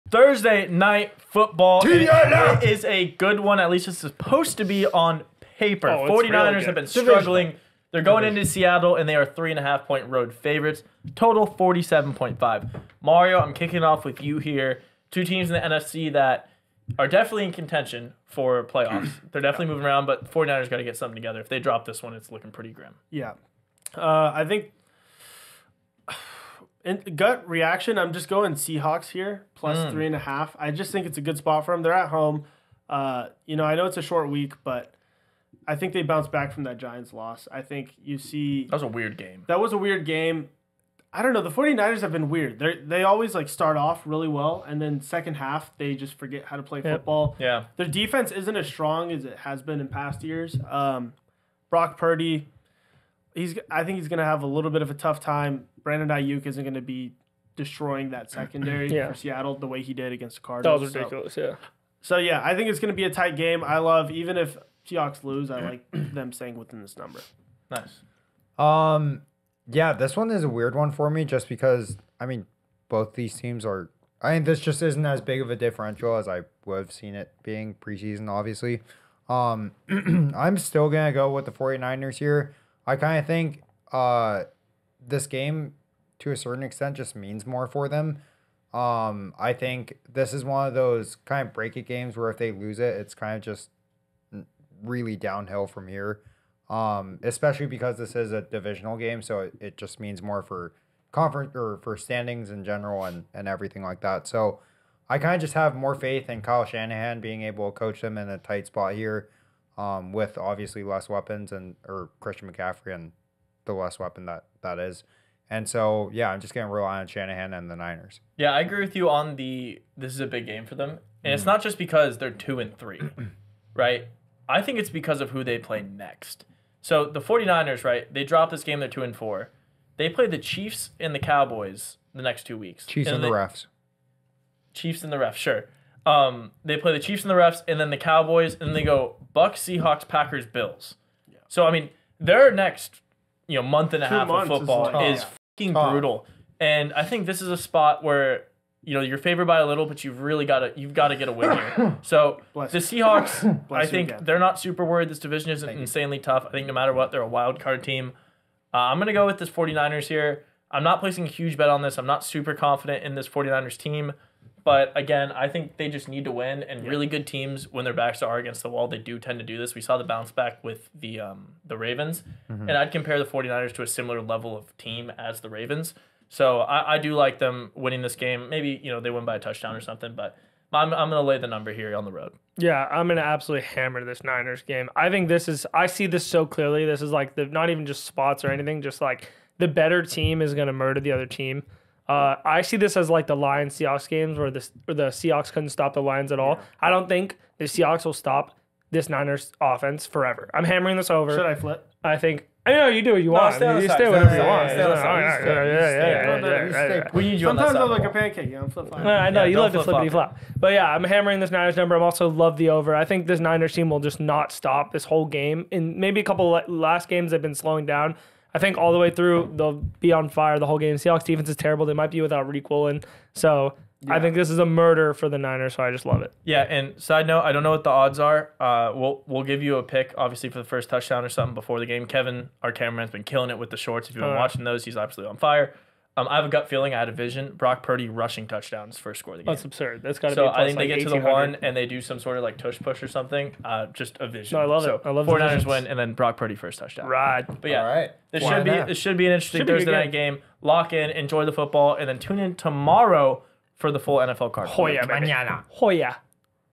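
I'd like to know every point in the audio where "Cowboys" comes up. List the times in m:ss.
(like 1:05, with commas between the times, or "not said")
2:11, 2:17.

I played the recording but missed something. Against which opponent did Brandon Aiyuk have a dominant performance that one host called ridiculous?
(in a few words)
Cardinals.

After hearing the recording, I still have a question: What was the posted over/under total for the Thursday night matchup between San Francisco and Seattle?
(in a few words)
47.5.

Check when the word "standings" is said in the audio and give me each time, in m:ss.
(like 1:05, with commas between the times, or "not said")
1:41.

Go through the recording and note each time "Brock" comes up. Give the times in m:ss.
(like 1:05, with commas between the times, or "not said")
0:51, 3:57, 4:06.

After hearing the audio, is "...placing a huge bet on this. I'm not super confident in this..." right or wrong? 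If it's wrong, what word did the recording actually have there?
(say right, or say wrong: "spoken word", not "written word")
right.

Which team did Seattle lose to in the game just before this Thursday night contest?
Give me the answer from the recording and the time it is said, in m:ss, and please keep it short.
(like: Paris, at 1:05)
Giants, at 0:36.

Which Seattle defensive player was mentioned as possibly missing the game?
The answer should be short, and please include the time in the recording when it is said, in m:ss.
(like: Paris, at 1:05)
Riq Woolen, at 3:42.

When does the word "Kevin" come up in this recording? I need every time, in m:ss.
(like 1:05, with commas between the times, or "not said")
3:52.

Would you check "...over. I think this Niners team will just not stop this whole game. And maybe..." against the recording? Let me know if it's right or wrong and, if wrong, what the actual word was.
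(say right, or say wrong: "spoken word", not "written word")
right.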